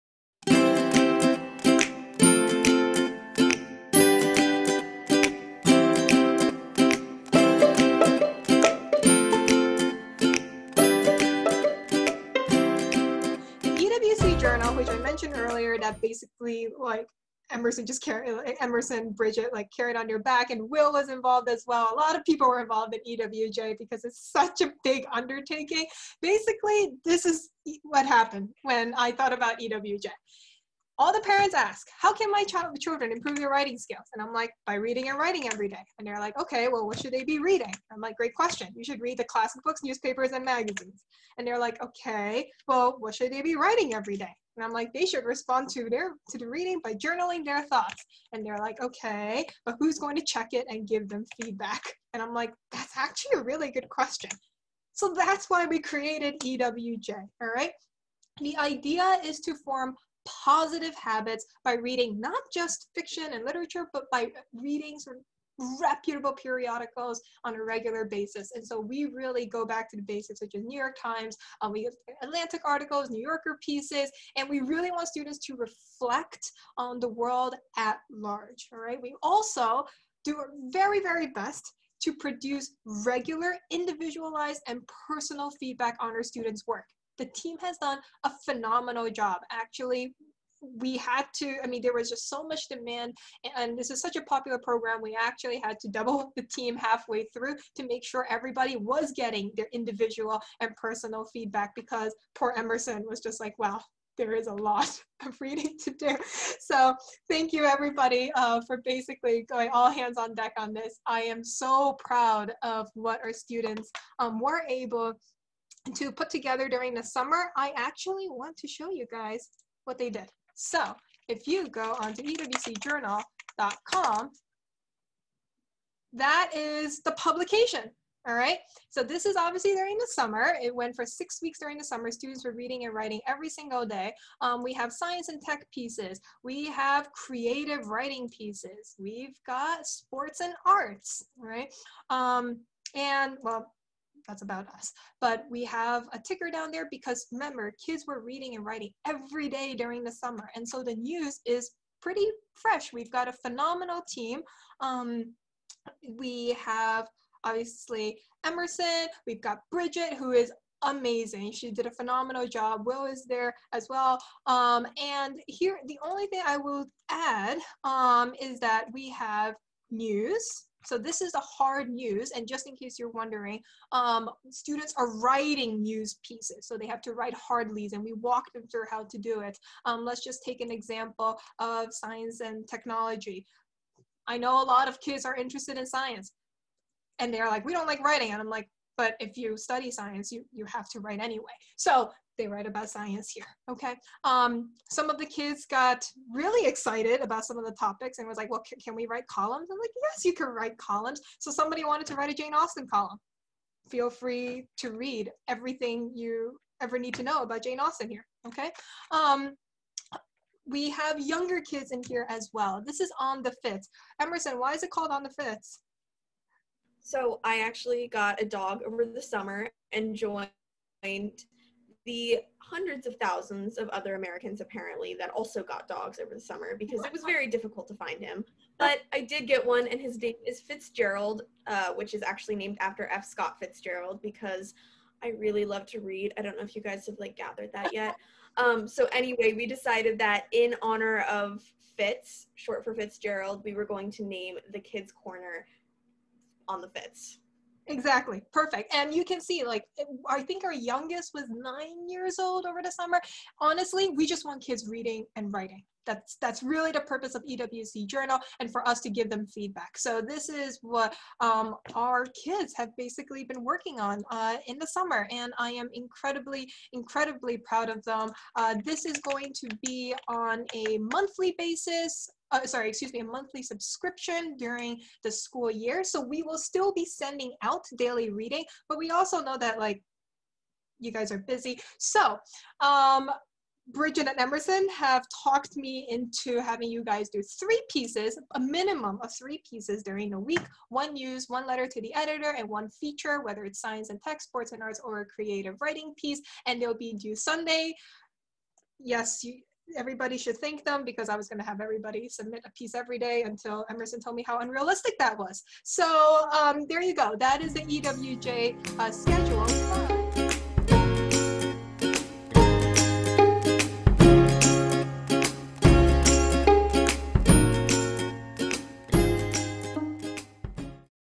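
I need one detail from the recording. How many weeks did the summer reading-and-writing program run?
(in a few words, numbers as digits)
6.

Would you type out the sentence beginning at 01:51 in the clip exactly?
I am so proud of what our students um, were able to put together during the summer.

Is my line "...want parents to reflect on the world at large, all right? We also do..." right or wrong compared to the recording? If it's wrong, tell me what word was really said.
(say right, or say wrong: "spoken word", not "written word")
wrong: "students", not "parents".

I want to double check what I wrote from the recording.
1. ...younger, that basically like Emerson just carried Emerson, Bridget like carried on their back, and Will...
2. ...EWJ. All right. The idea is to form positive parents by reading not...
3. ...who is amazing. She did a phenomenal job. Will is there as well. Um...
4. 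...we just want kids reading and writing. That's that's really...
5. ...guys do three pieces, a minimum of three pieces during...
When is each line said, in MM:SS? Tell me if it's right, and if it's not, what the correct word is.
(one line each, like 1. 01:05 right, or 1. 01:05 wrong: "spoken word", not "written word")
1. 00:15 wrong: "earlier", not "younger"
2. 00:56 wrong: "habits", not "parents"
3. 02:40 right
4. 04:14 right
5. 04:47 right.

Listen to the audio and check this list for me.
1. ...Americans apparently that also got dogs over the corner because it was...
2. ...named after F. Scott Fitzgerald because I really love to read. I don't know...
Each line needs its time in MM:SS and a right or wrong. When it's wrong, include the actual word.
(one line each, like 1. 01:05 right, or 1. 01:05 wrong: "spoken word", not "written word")
1. 03:44 wrong: "summer", not "corner"
2. 03:52 right.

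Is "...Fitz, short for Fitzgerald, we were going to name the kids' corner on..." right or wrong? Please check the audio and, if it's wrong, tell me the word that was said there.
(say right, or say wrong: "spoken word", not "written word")
right.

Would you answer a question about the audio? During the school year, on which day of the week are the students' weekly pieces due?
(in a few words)
Sunday.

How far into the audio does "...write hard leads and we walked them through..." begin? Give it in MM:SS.
02:57.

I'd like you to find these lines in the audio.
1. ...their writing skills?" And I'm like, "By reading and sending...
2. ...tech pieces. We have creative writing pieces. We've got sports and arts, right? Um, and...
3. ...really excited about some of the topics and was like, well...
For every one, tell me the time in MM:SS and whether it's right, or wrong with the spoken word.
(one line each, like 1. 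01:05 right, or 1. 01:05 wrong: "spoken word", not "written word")
1. 00:33 wrong: "writing", not "sending"
2. 02:15 right
3. 03:16 right.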